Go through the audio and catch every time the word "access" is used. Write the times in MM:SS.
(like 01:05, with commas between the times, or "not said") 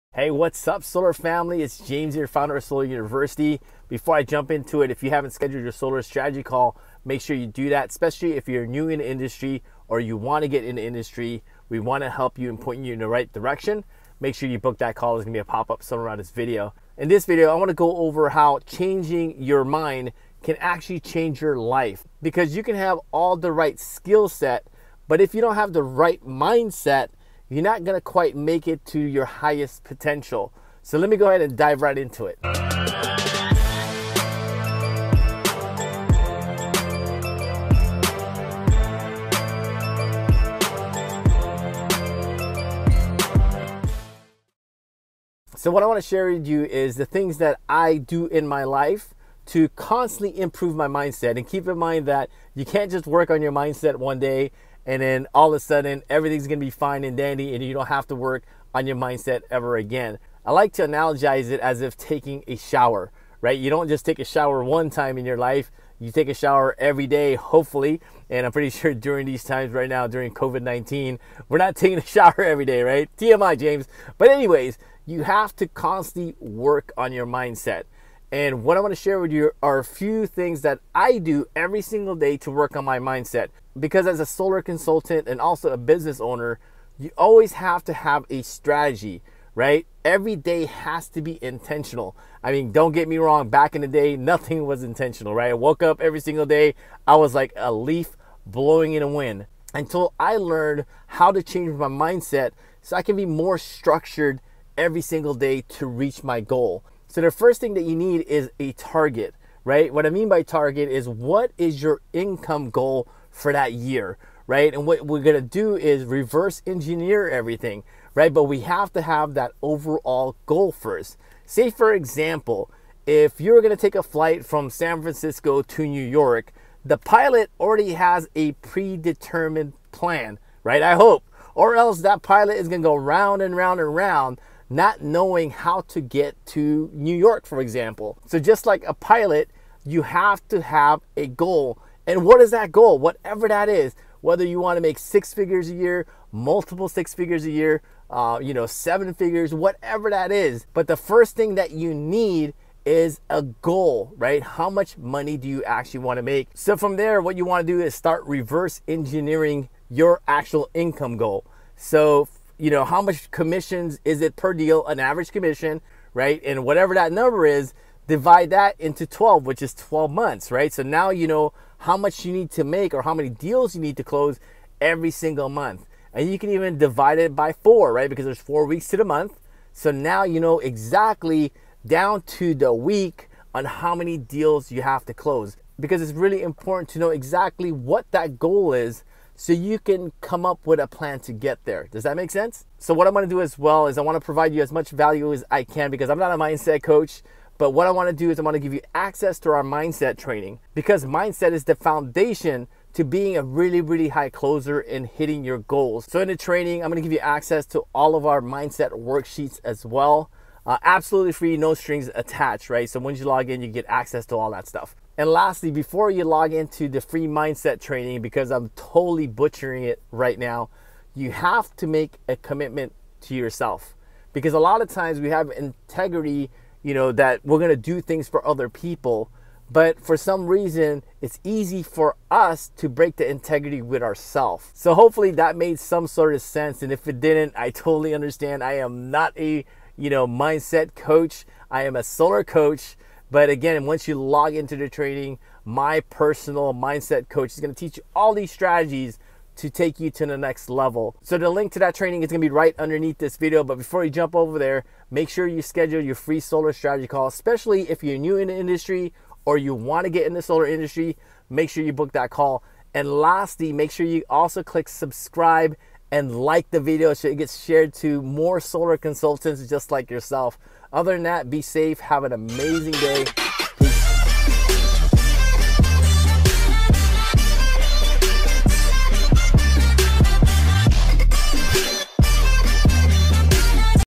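03:18, 03:27, 03:33.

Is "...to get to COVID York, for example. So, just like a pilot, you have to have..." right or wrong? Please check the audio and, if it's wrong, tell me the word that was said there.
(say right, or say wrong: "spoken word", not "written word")
wrong: "New", not "COVID".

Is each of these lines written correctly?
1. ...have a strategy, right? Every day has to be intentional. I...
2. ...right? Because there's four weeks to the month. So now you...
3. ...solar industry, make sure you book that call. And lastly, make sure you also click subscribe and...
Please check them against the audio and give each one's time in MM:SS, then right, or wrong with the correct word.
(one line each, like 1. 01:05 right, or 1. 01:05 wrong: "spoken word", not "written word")
1. 01:27 right
2. 02:57 right
3. 04:20 right.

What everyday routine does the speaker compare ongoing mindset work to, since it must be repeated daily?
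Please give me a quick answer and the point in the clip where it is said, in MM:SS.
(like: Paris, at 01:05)
Taking a shower, at 01:01.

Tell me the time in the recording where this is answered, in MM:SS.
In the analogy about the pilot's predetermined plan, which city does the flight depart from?
02:04.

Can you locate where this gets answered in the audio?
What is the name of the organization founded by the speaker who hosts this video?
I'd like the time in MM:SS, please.
00:02.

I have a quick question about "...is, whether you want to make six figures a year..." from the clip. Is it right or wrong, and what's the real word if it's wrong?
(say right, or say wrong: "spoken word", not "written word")
right.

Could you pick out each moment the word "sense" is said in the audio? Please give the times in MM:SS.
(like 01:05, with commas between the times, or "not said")
03:12, 03:56.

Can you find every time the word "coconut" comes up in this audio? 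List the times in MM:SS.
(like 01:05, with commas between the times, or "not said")
not said.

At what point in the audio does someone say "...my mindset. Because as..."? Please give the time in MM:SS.
01:22.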